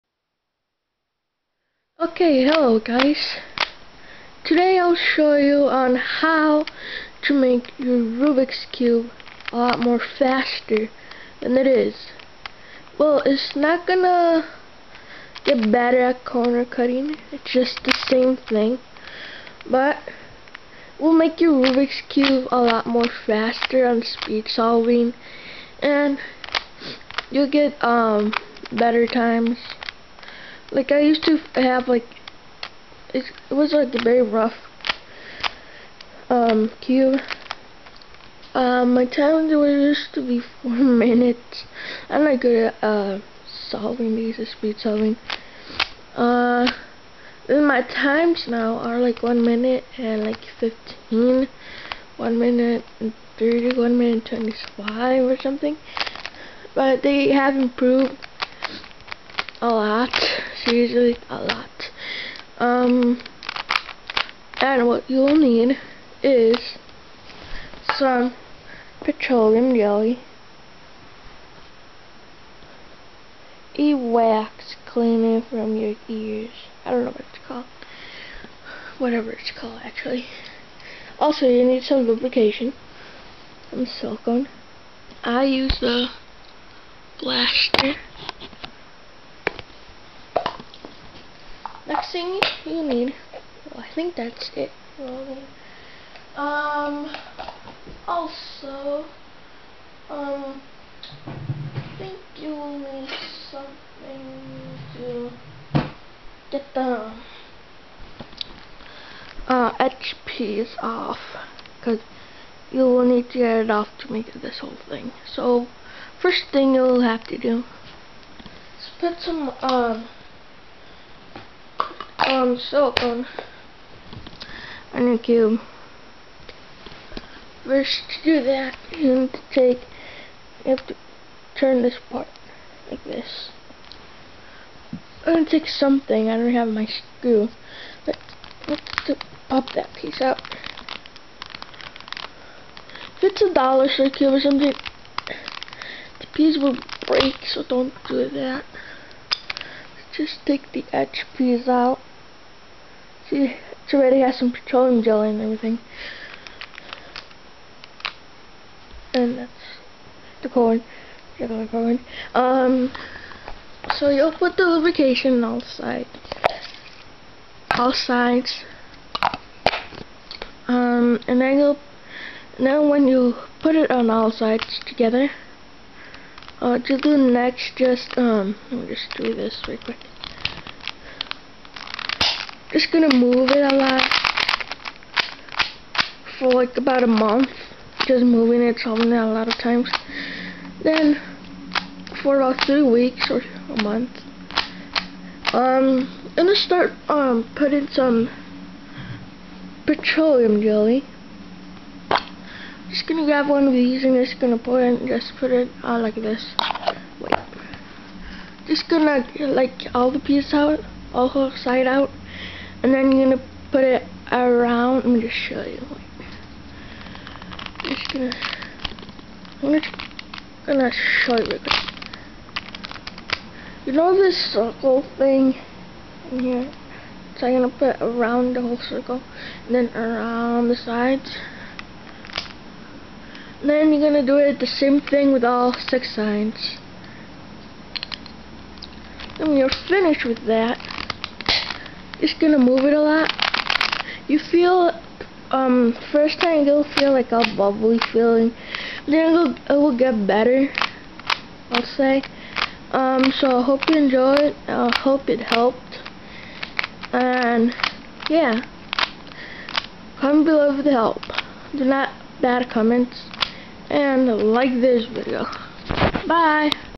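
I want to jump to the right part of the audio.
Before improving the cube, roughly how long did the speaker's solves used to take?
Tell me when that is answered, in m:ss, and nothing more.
0:40.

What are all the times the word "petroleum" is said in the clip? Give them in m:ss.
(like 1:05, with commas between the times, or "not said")
1:09, 2:34, 3:19.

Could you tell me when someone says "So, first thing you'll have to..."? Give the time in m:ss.
1:55.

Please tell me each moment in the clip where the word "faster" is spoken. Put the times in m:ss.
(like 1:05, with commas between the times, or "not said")
0:10, 0:23.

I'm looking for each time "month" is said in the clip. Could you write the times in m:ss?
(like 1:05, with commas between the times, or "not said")
3:07, 3:13.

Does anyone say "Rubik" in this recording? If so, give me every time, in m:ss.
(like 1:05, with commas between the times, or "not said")
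0:07, 0:21.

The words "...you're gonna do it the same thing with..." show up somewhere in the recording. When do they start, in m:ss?
3:53.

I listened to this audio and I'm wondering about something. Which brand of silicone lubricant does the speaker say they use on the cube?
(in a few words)
Blaster.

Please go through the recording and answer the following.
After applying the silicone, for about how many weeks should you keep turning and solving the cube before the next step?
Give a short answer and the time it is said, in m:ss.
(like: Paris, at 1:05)
3 weeks, at 3:12.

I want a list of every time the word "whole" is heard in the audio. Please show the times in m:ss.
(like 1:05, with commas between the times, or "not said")
1:54, 3:48.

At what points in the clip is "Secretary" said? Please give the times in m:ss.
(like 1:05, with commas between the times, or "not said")
not said.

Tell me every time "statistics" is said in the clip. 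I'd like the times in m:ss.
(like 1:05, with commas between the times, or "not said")
not said.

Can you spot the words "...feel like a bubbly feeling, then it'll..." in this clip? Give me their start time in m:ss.
4:06.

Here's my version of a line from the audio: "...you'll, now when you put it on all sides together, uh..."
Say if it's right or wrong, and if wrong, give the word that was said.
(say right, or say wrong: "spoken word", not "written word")
right.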